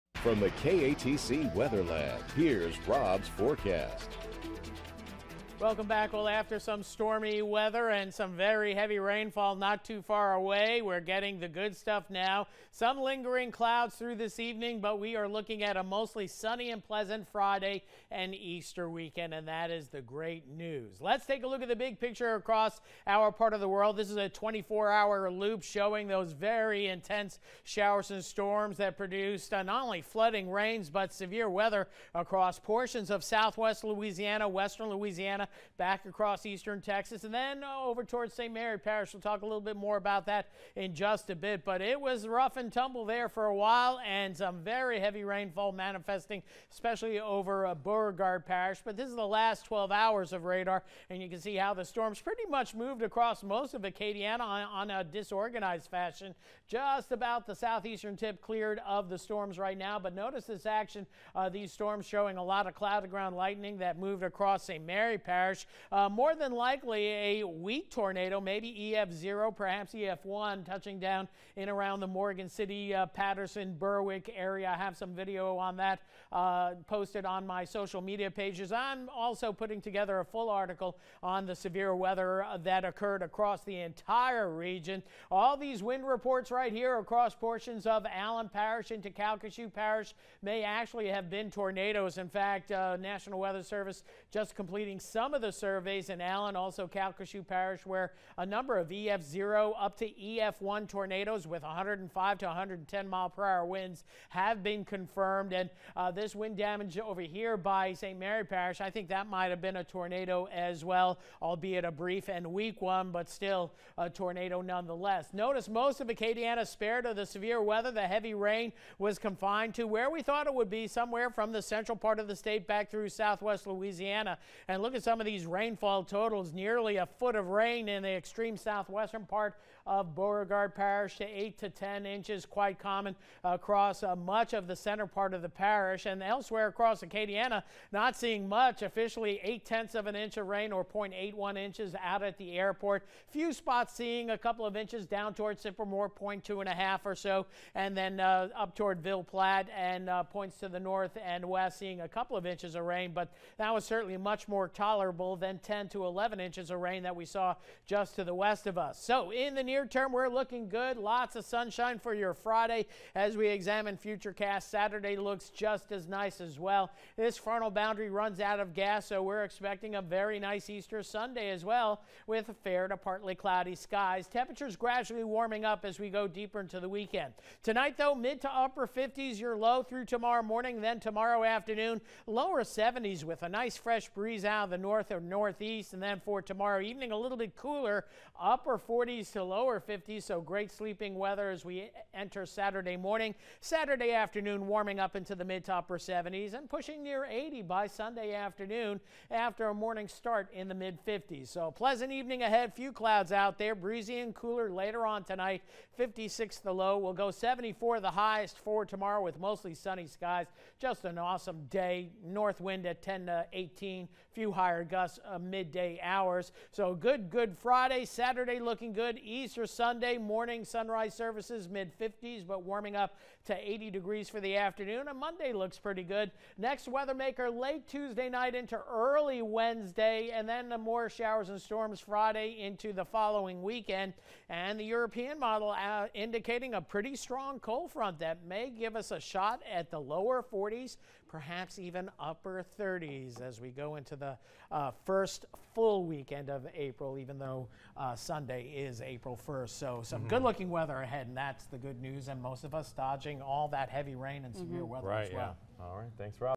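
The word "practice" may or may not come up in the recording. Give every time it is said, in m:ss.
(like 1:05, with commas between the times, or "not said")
not said.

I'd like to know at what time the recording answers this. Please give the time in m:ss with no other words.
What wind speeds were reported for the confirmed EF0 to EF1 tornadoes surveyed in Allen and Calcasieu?
1:41.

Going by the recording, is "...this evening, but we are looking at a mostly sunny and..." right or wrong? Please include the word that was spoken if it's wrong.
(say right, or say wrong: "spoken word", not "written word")
right.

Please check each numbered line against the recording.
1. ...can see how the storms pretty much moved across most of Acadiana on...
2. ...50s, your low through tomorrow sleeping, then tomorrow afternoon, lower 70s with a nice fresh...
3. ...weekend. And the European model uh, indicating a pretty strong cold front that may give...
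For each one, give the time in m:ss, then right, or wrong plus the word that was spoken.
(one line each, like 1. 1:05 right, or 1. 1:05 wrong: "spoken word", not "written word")
1. 0:51 right
2. 2:58 wrong: "morning", not "sleeping"
3. 3:53 right.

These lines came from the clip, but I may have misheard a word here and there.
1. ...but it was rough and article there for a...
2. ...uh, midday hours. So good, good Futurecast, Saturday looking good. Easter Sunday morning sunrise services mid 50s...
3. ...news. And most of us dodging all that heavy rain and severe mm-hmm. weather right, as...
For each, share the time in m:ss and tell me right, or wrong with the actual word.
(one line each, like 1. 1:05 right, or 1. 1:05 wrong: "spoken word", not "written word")
1. 0:41 wrong: "tumble", not "article"
2. 3:35 wrong: "Friday", not "Futurecast"
3. 4:12 right.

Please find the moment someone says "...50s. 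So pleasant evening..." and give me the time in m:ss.
3:21.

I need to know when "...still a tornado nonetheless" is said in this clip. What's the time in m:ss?
1:53.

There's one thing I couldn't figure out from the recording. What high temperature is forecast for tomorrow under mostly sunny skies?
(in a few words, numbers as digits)
74.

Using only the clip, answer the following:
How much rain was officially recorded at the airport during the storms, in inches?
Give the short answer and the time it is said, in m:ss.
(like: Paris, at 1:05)
0.81 inches, at 2:20.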